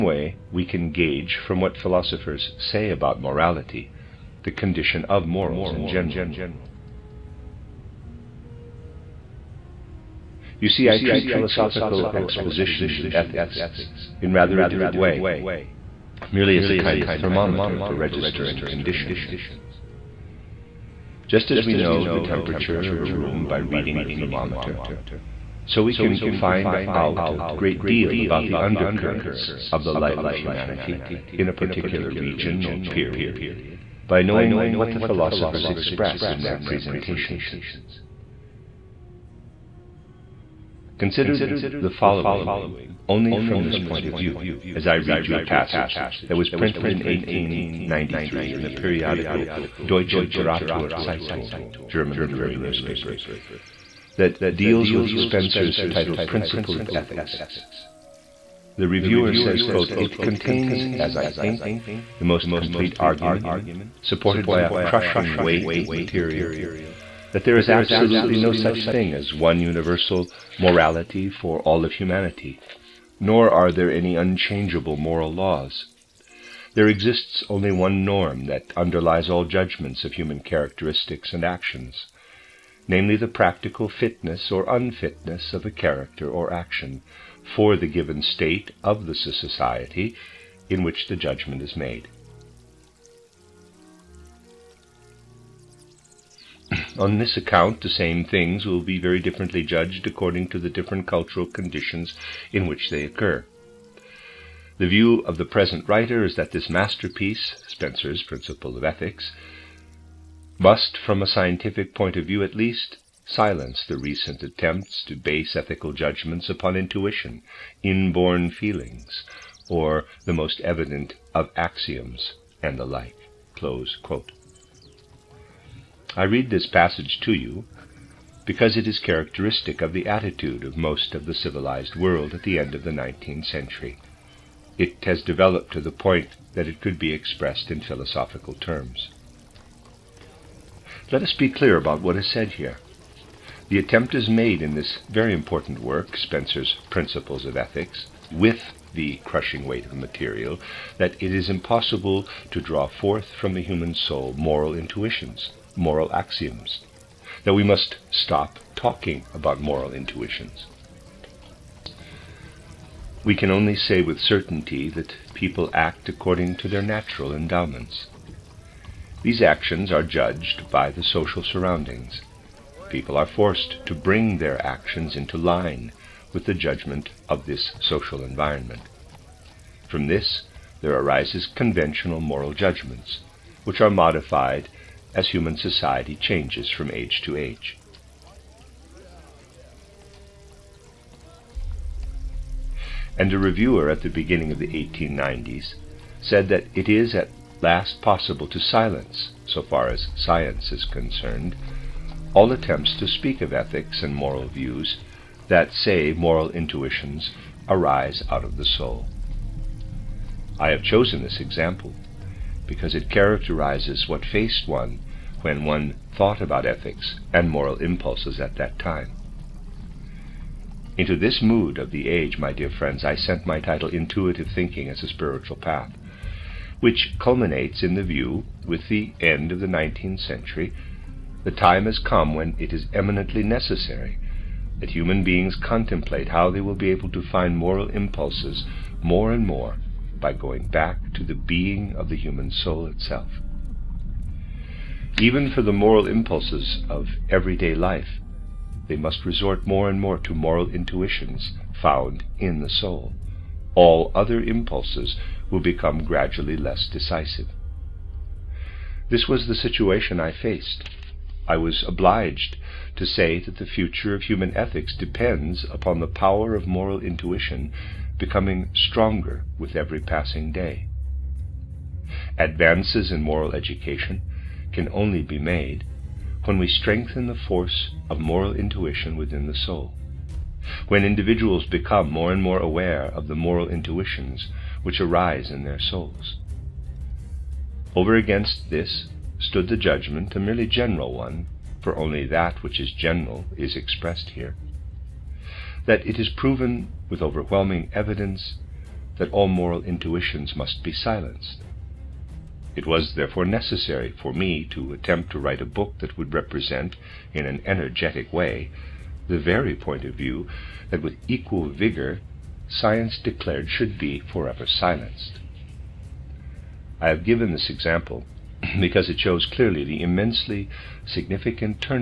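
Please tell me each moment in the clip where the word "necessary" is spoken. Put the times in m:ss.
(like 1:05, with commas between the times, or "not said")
3:53, 5:03.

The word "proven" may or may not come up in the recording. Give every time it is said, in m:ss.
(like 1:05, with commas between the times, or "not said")
4:56.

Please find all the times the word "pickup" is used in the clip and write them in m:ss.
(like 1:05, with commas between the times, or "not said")
not said.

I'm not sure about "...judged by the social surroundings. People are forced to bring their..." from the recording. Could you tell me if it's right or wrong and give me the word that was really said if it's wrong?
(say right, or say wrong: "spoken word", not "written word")
right.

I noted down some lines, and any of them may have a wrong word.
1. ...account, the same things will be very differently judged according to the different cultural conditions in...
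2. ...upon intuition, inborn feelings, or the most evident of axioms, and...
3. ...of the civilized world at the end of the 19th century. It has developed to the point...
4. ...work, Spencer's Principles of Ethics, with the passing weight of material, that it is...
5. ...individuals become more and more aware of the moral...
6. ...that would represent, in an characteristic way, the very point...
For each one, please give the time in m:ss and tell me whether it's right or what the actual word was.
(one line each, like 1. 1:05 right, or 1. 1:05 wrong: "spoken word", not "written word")
1. 1:37 right
2. 1:56 right
3. 2:11 right
4. 2:25 wrong: "crushing", not "passing"
5. 4:41 right
6. 5:05 wrong: "energetic", not "characteristic".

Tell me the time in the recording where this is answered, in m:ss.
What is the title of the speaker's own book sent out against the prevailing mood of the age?
3:43.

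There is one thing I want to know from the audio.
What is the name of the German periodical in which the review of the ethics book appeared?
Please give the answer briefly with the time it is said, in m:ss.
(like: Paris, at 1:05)
Deutsche Literaturzeitung, at 0:49.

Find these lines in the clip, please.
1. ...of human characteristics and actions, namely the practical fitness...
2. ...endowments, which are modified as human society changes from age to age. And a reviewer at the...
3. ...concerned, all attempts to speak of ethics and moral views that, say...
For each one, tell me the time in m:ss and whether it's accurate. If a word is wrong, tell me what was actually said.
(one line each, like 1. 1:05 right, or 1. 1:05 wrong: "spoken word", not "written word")
1. 1:20 right
2. 3:02 wrong: "judgments", not "endowments"
3. 3:20 right.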